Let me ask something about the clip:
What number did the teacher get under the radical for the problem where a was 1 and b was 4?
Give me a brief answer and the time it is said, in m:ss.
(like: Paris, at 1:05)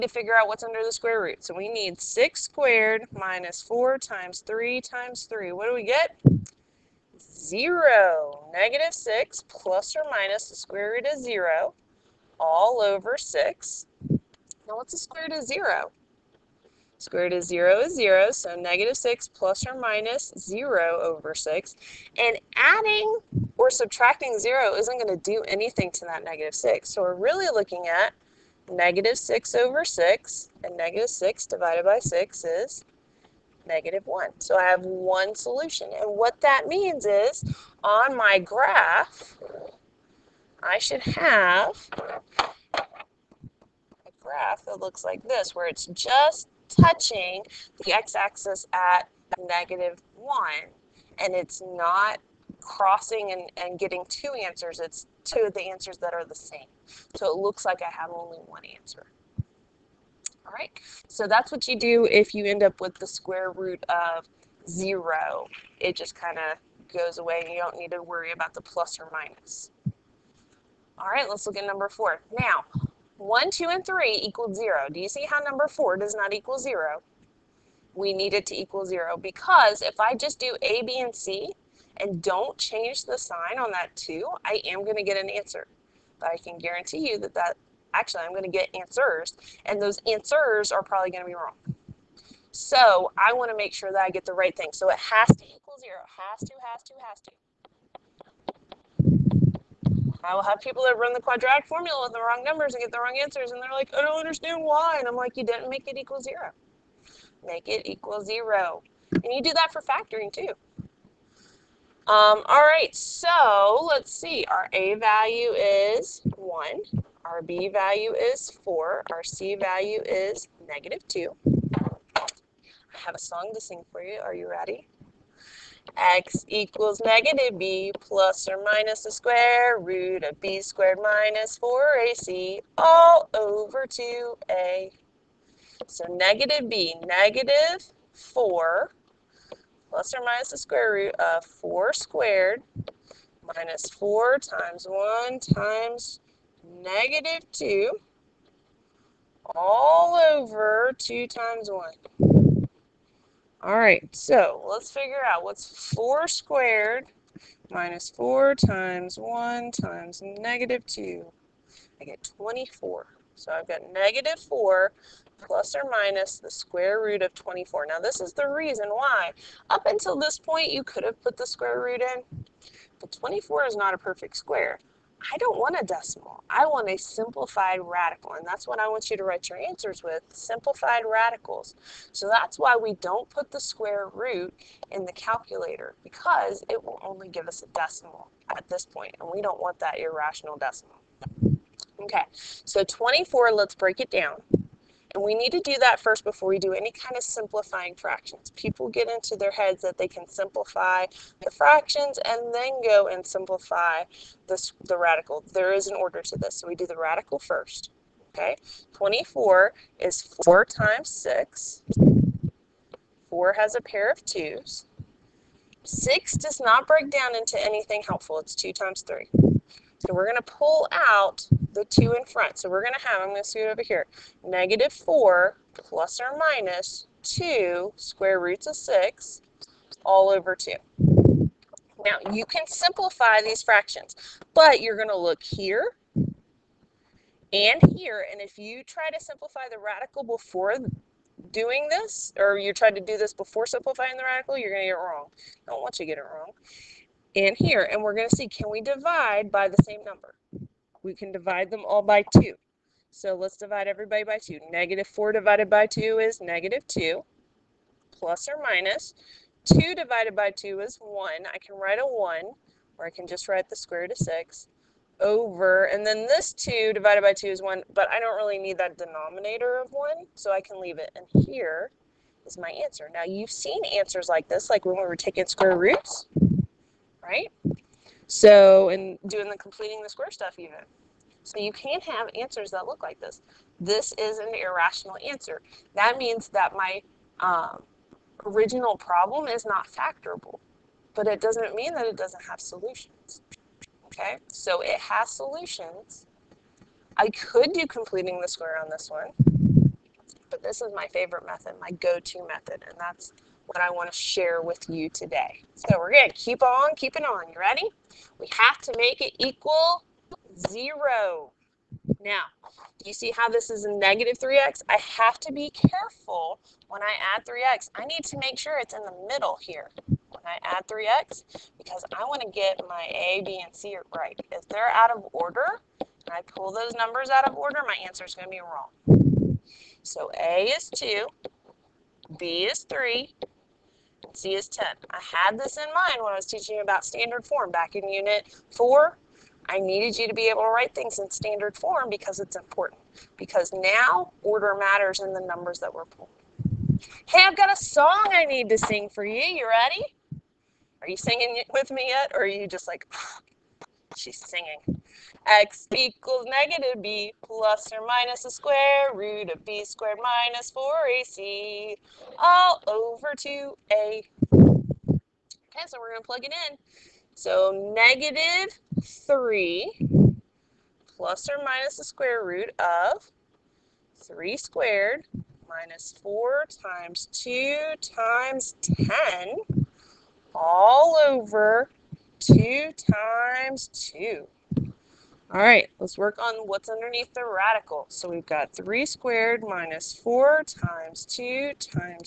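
24, at 2:42.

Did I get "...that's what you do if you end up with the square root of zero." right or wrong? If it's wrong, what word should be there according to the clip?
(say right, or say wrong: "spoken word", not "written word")
right.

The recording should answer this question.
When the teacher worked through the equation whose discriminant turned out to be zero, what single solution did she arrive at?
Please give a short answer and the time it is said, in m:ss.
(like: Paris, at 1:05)
-1, at 0:30.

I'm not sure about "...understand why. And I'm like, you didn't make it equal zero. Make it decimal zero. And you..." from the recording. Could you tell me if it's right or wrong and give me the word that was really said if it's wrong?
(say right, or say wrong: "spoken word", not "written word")
wrong: "equal", not "decimal".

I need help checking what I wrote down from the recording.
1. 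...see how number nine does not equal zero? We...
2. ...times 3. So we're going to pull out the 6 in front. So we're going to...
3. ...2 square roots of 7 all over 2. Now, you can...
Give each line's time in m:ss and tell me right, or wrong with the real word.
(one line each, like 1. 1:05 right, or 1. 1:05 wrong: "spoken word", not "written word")
1. 1:15 wrong: "four", not "nine"
2. 3:38 wrong: "2", not "6"
3. 3:47 wrong: "6", not "7".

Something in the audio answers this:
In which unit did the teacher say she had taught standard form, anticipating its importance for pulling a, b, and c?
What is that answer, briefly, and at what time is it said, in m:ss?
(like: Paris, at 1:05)
Unit 4, at 5:38.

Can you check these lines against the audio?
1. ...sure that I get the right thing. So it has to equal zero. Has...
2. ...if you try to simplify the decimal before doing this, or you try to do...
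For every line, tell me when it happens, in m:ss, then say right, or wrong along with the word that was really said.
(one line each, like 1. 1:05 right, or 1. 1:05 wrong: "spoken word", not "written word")
1. 1:33 right
2. 3:58 wrong: "radical", not "decimal".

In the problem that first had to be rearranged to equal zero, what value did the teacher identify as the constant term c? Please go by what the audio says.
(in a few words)
-2.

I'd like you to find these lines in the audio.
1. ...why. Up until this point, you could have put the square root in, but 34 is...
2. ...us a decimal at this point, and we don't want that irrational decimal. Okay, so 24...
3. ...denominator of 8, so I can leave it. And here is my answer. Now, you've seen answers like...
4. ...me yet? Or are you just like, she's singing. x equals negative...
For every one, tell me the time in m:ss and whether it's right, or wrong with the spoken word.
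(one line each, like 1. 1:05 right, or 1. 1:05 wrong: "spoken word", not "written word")
1. 2:48 wrong: "24", not "34"
2. 3:07 right
3. 4:28 wrong: "1", not "8"
4. 5:51 right.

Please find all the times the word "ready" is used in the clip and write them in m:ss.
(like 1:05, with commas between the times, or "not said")
2:04, 5:07, 5:49.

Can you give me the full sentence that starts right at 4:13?
So let's divide everybody by 2.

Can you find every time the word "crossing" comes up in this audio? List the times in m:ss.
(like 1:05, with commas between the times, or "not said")
0:52.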